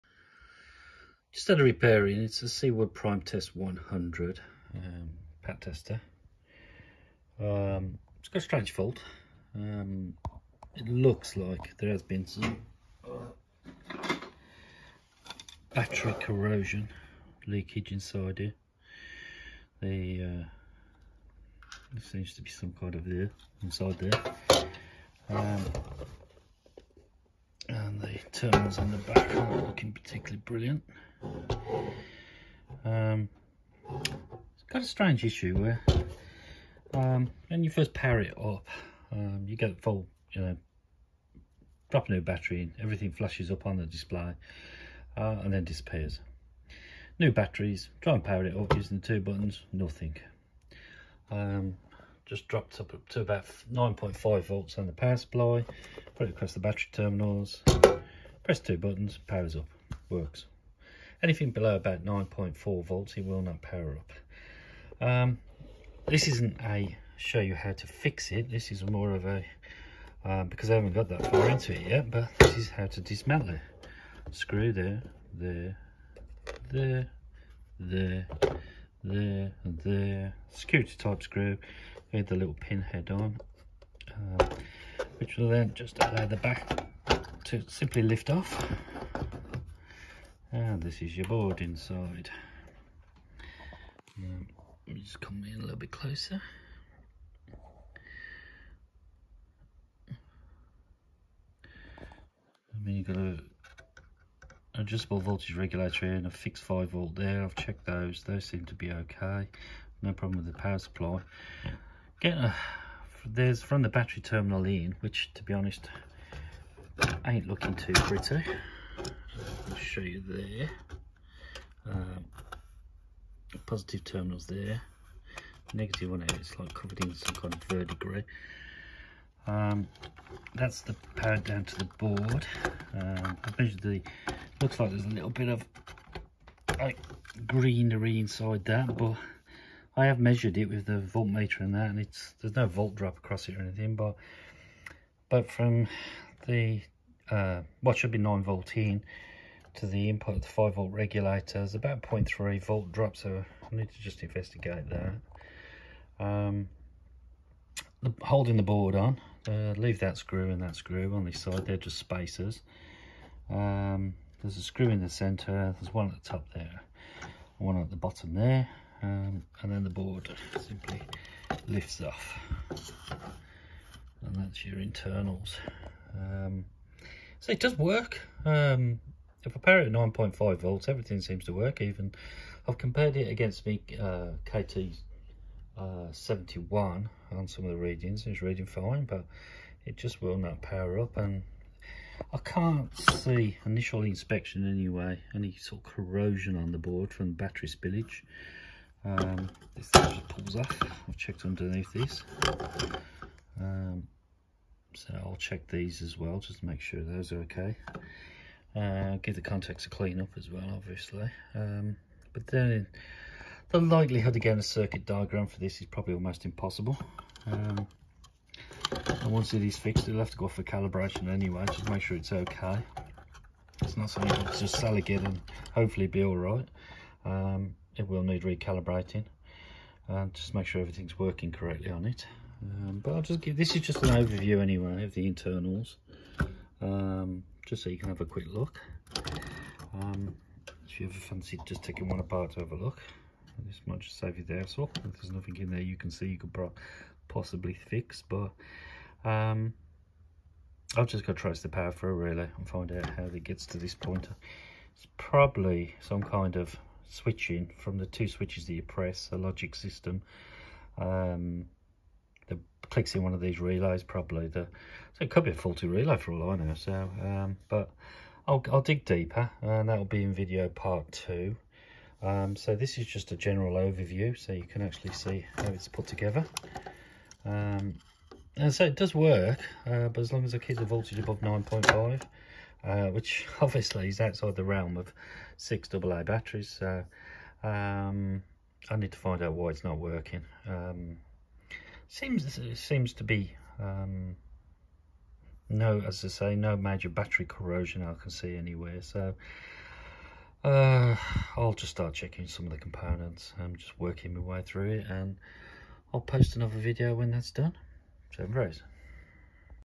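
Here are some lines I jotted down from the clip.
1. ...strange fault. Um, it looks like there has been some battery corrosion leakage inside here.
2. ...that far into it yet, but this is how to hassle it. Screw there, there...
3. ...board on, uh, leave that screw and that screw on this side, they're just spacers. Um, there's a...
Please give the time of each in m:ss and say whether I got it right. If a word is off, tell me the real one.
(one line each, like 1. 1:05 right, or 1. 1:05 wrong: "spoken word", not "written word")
1. 0:08 right
2. 1:11 wrong: "dismantle", not "hassle"
3. 2:38 right.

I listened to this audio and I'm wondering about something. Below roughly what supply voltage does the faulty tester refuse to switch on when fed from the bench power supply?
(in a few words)
9.4 volts.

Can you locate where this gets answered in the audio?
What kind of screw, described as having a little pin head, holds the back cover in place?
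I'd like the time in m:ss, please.
1:20.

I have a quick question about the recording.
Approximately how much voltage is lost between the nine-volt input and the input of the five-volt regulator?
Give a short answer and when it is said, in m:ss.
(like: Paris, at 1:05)
0.3 volt, at 2:32.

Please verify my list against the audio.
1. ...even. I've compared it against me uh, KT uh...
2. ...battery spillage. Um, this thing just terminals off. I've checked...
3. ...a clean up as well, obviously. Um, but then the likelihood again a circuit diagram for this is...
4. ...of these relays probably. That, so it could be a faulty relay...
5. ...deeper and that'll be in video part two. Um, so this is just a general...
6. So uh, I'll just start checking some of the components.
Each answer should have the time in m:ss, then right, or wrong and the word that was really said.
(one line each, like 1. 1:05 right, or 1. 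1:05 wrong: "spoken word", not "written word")
1. 3:01 right
2. 3:17 wrong: "pulls", not "terminals"
3. 3:29 right
4. 4:23 right
5. 4:29 right
6. 4:59 right.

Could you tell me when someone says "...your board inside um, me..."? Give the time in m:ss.
1:31.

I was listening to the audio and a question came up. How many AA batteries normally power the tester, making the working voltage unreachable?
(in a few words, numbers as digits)
6.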